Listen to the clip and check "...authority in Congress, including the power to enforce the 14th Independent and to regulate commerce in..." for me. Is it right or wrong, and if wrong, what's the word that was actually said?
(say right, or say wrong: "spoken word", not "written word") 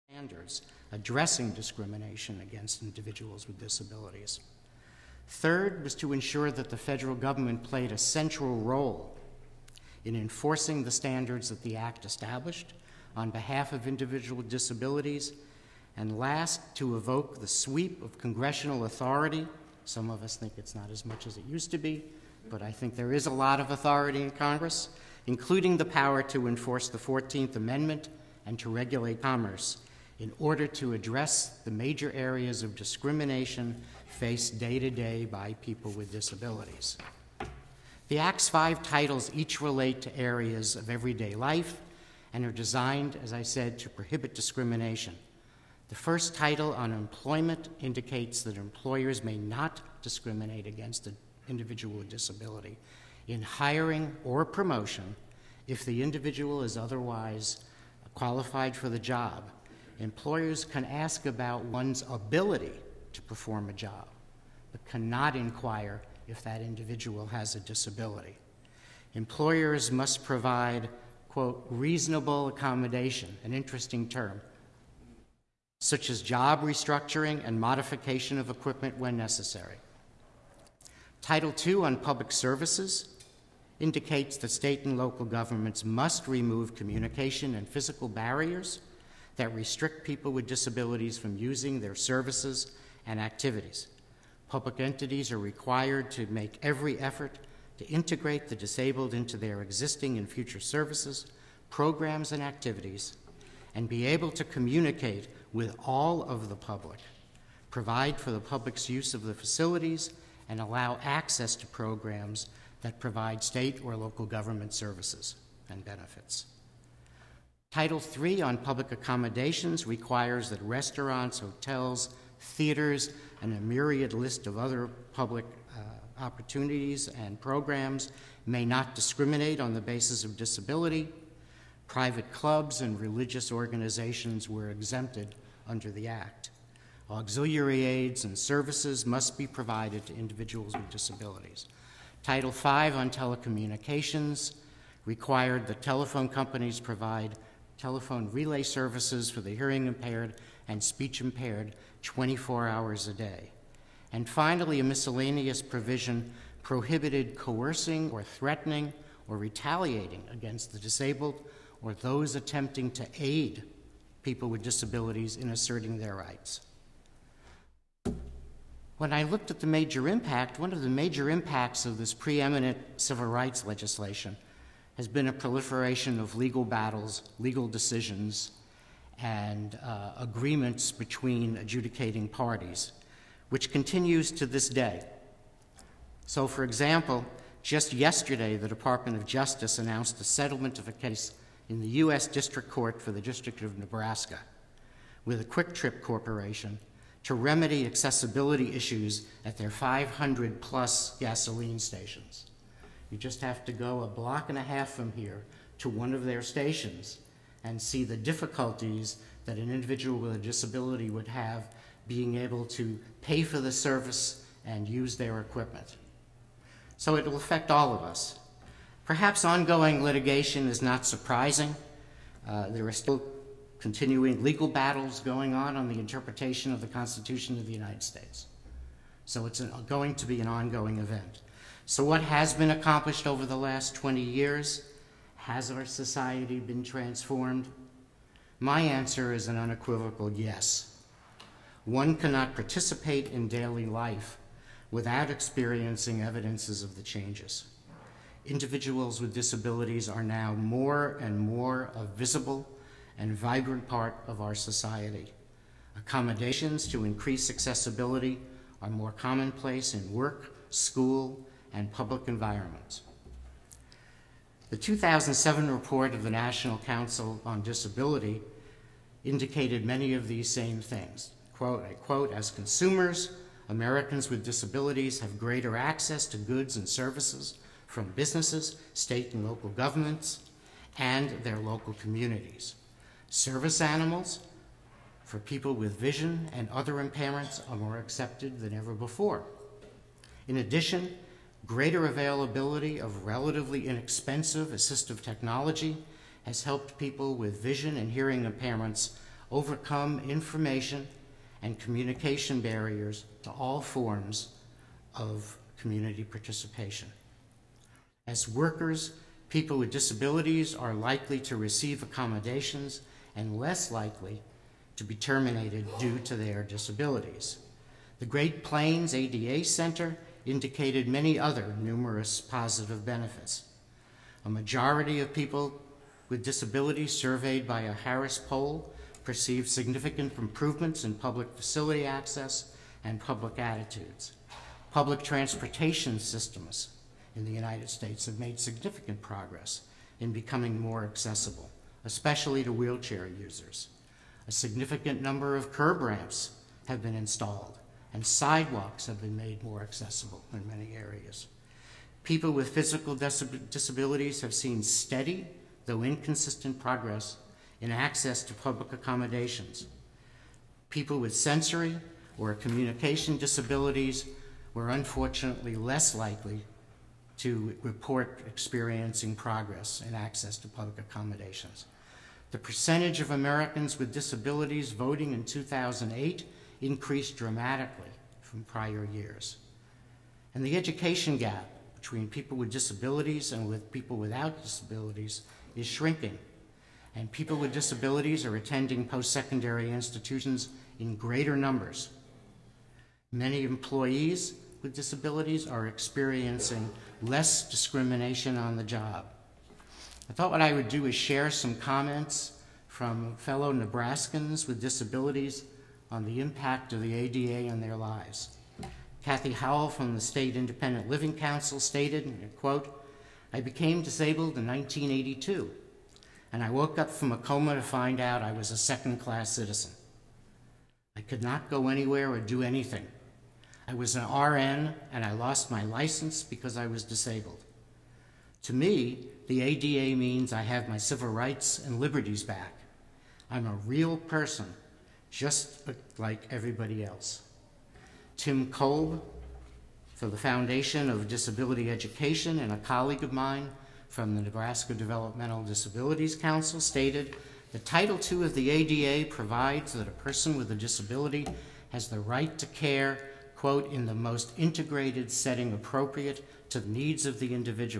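wrong: "Amendment", not "Independent".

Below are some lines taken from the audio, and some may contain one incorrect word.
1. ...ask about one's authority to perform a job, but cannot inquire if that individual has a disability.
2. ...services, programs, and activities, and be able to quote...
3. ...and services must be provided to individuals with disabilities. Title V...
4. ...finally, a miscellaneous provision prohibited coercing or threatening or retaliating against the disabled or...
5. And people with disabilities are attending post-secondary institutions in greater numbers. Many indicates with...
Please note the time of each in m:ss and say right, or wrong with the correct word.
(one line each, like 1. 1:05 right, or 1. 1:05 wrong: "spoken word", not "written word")
1. 1:00 wrong: "ability", not "authority"
2. 1:40 wrong: "communicate", not "quote"
3. 2:18 right
4. 2:34 right
5. 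6:27 wrong: "employees", not "indicates".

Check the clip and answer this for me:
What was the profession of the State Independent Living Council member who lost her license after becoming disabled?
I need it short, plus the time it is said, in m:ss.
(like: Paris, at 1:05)
RN, at 7:04.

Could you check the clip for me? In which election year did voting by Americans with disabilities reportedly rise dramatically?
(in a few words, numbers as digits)
2008.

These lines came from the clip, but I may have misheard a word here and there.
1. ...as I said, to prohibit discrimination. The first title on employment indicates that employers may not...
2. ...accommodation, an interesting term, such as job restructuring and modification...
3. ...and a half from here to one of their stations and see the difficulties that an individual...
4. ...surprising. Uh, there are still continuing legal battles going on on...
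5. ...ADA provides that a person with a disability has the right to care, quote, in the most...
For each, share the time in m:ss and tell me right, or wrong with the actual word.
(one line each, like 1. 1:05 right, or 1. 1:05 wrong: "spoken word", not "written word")
1. 0:43 right
2. 1:12 right
3. 3:24 right
4. 3:41 right
5. 7:28 right.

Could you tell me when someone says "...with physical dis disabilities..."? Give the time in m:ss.
5:52.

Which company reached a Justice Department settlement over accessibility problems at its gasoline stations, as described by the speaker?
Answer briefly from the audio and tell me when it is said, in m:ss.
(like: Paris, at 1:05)
QuikTrip Corporation, at 3:15.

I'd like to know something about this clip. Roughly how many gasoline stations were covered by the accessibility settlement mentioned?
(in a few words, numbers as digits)
500.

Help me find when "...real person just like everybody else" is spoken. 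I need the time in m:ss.
7:13.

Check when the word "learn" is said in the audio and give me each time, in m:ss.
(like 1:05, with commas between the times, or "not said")
not said.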